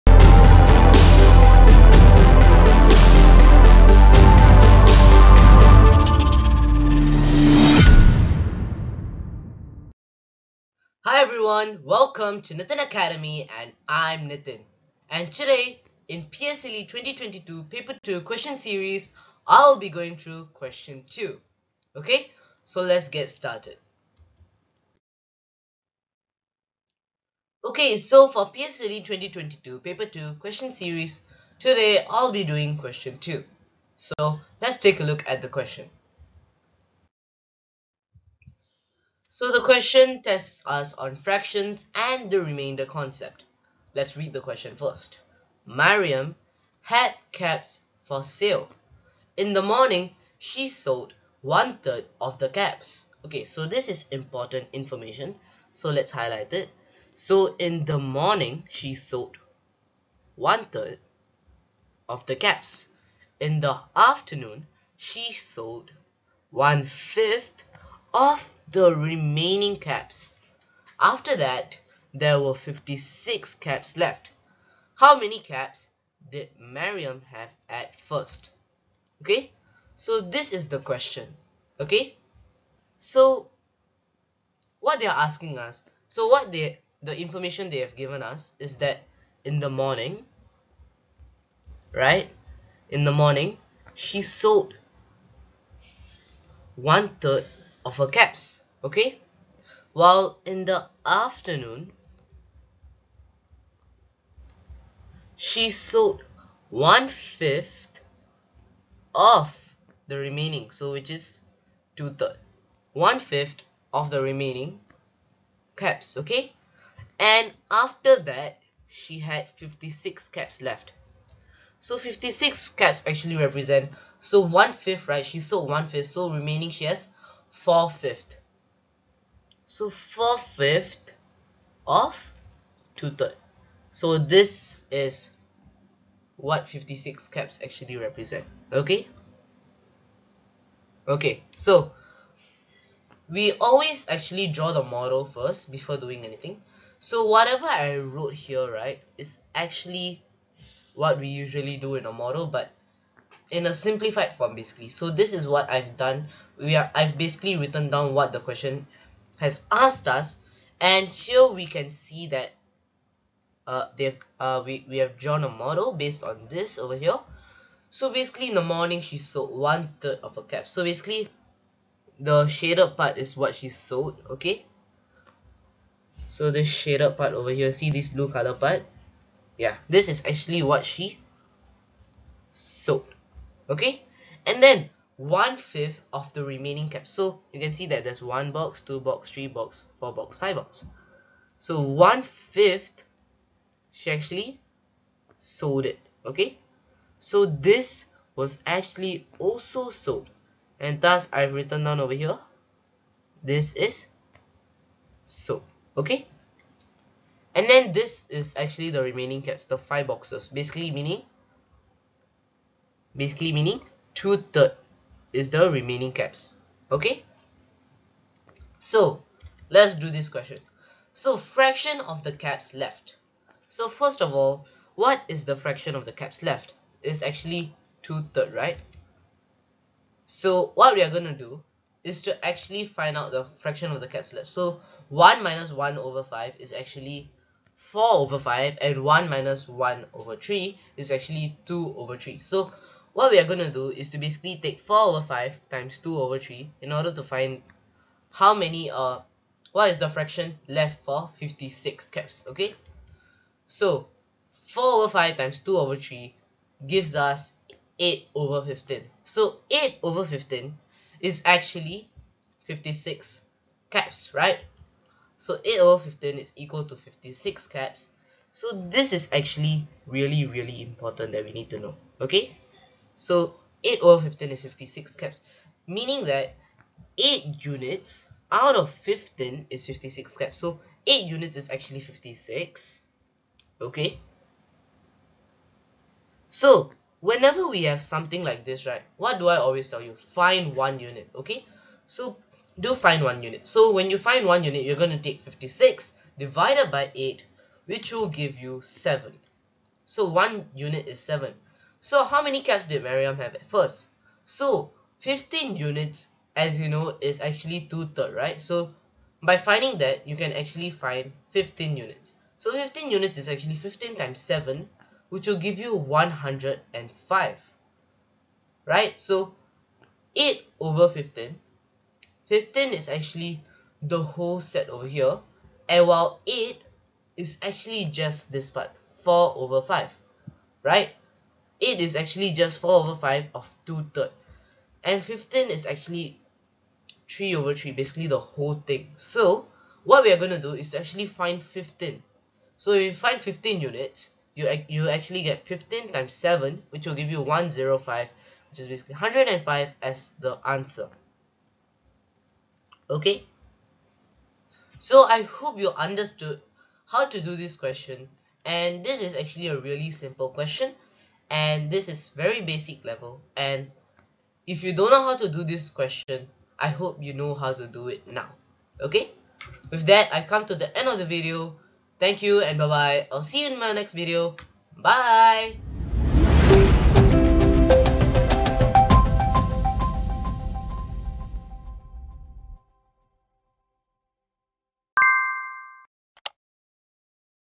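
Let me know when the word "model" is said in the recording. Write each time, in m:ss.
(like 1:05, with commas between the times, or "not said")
2:24, 2:32, 2:45.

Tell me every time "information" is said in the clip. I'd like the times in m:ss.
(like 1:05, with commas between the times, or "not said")
0:54, 1:27.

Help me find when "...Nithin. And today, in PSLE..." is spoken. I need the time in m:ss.
0:14.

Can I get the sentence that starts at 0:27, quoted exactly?
Okay, so for PSLE 2022 Paper 2 question series, today I'll be doing question 2.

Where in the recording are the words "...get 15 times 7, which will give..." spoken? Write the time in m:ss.
5:45.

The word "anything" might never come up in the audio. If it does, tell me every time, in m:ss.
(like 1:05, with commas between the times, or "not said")
2:26.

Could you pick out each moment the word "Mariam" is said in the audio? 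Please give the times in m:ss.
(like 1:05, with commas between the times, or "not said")
0:45, 1:16, 5:03.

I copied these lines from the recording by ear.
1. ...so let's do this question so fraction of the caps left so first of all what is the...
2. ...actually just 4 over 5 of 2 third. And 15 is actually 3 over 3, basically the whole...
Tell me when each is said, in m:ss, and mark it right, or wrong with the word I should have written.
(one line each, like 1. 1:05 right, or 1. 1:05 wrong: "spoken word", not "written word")
1. 3:38 right
2. 5:32 right.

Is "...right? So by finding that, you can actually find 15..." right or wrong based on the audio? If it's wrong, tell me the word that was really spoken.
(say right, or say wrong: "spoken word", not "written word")
right.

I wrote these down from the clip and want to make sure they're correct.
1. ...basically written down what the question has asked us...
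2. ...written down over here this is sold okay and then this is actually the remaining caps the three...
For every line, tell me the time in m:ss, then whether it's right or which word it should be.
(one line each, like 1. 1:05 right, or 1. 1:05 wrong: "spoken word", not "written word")
1. 2:37 right
2. 3:21 wrong: "five", not "three".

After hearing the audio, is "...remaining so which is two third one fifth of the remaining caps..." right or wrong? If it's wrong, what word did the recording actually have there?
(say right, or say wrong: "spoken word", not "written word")
right.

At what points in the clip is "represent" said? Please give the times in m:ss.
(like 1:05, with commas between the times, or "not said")
2:03, 2:17.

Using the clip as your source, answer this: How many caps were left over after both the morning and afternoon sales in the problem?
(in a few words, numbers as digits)
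56.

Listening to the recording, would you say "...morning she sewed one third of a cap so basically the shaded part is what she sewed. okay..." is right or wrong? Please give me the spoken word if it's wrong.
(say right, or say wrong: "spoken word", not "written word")
right.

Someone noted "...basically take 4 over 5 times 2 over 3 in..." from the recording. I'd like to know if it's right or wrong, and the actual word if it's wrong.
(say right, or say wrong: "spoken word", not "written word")
right.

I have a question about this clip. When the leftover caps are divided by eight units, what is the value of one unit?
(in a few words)
7.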